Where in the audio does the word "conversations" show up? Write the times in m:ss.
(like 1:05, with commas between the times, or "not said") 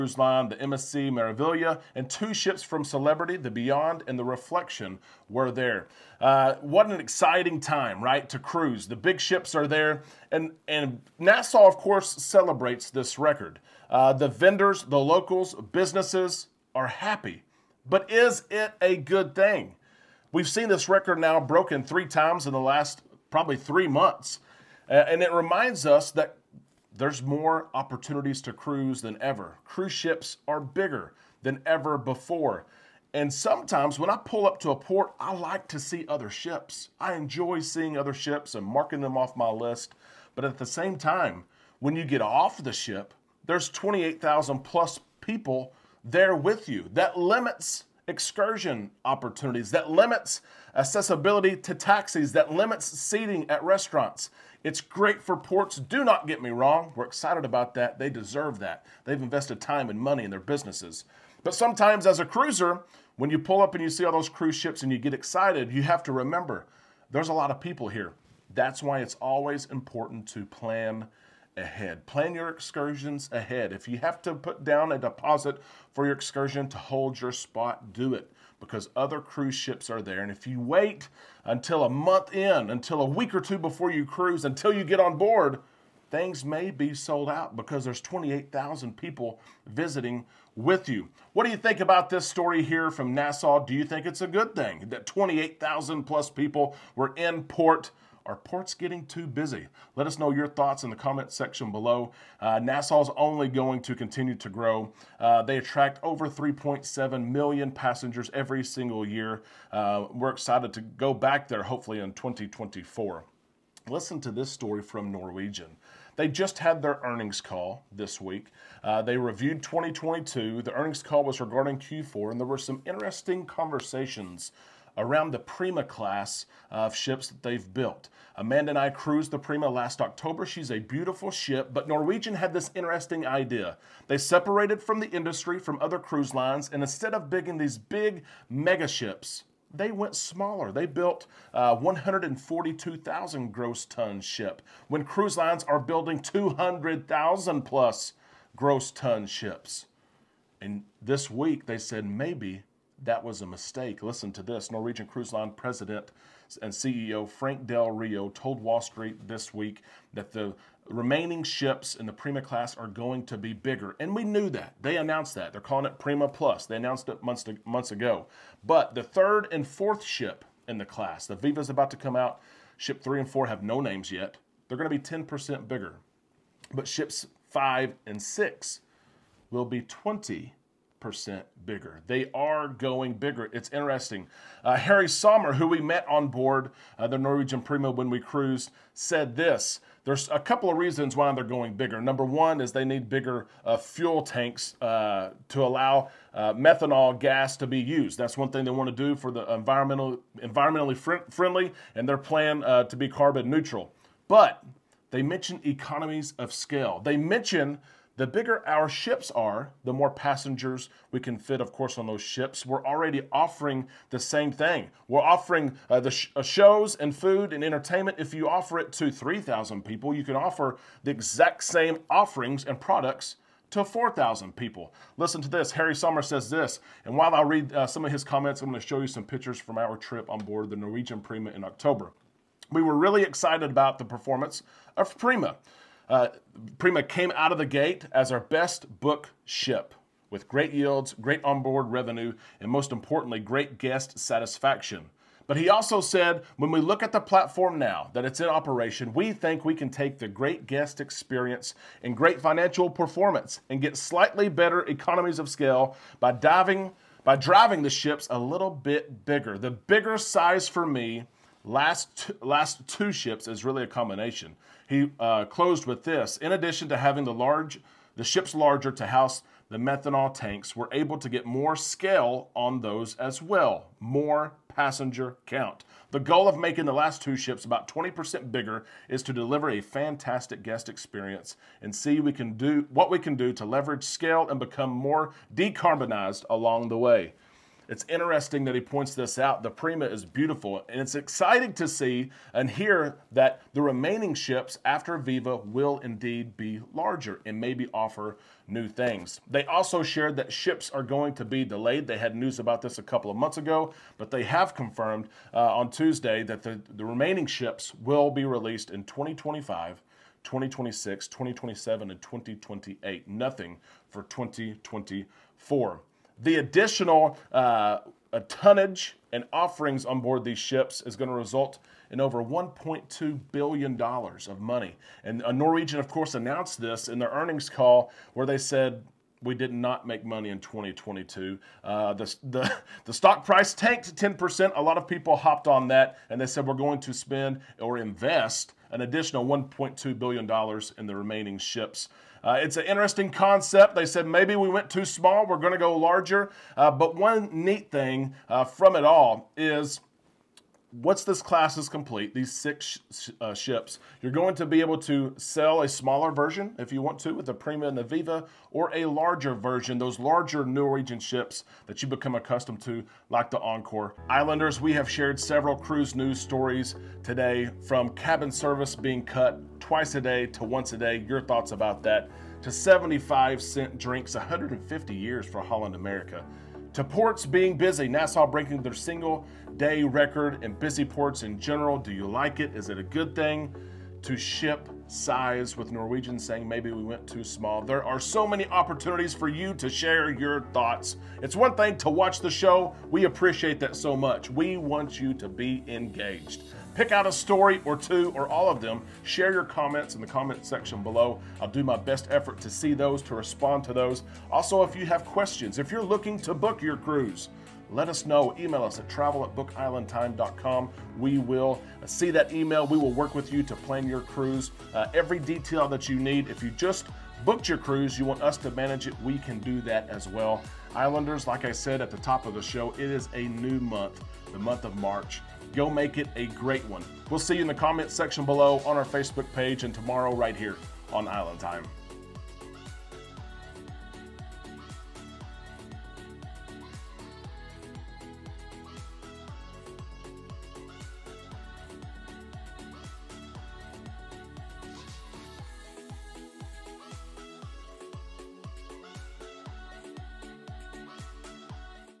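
2:03.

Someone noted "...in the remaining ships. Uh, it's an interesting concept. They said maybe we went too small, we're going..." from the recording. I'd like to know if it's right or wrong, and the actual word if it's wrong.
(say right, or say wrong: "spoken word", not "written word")
right.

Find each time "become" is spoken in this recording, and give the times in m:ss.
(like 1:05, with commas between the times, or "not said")
4:44, 6:02.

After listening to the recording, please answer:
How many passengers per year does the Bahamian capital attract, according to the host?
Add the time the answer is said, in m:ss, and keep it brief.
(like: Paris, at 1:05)
3.7 million, at 1:46.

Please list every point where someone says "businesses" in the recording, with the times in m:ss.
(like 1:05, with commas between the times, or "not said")
0:15, 1:00.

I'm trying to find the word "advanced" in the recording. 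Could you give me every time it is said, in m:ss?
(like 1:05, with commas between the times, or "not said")
not said.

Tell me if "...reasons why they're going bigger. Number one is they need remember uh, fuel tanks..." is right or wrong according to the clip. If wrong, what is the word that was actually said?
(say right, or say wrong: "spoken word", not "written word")
wrong: "bigger", not "remember".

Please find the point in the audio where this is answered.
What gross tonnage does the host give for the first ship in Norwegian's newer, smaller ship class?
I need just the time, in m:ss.
2:21.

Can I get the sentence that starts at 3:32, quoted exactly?
We're already offering the same thing.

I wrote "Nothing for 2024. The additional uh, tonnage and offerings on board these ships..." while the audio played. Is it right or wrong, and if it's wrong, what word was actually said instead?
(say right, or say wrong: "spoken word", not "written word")
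right.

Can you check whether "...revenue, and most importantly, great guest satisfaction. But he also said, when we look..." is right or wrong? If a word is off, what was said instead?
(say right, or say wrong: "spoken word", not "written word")
right.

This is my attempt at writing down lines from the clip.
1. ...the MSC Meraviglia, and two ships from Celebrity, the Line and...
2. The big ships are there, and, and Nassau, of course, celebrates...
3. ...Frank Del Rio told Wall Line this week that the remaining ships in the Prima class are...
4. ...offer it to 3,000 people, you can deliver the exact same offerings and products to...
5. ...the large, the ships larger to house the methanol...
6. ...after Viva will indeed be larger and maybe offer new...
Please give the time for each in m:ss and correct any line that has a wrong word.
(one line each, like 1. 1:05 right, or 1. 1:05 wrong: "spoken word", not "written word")
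1. 0:00 wrong: "Beyond", not "Line"
2. 0:08 right
3. 2:37 wrong: "Street", not "Line"
4. 3:38 wrong: "offer", not "deliver"
5. 4:27 right
6. 4:54 right.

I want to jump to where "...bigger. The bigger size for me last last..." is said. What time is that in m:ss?
4:19.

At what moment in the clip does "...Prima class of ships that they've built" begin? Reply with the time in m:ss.
2:05.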